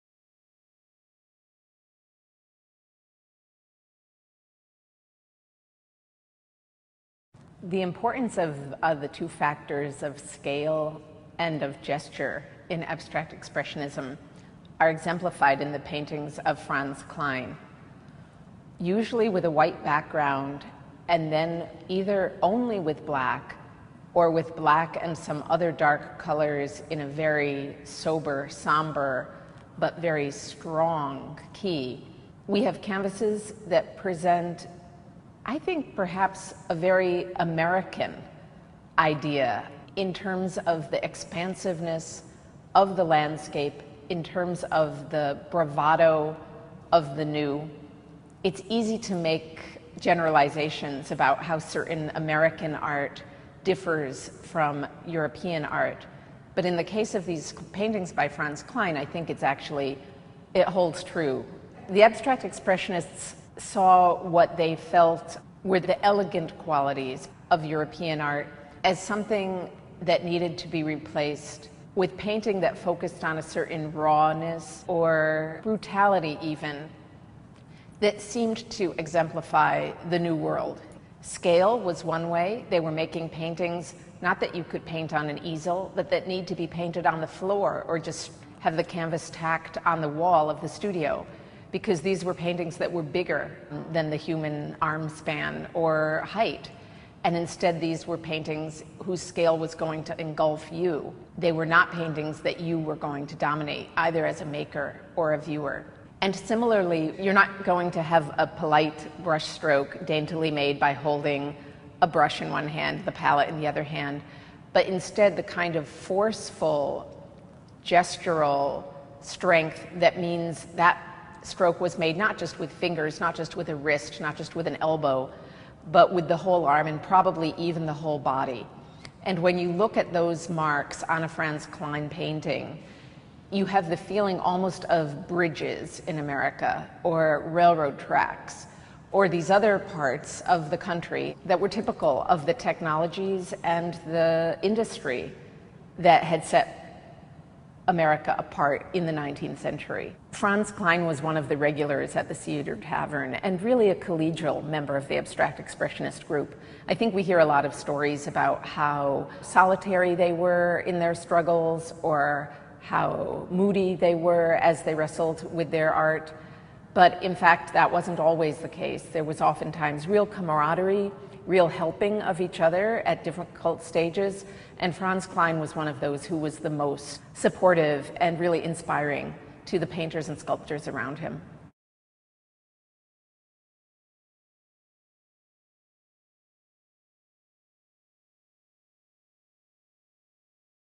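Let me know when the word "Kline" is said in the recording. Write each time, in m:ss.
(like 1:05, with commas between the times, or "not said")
0:17, 0:58, 2:11, 2:30, 2:55.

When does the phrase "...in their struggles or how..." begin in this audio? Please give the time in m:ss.
2:40.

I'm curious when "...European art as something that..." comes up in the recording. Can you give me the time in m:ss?
1:07.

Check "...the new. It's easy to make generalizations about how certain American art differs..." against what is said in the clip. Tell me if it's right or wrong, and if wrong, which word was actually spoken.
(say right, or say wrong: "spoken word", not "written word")
right.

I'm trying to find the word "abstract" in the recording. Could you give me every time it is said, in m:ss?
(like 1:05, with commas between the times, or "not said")
0:12, 1:02, 2:35.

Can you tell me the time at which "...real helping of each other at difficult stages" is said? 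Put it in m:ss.
2:51.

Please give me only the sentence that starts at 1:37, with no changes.
And instead, these were paintings whose scale was going to engulf you.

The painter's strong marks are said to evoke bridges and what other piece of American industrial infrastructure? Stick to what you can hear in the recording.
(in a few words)
railroad tracks.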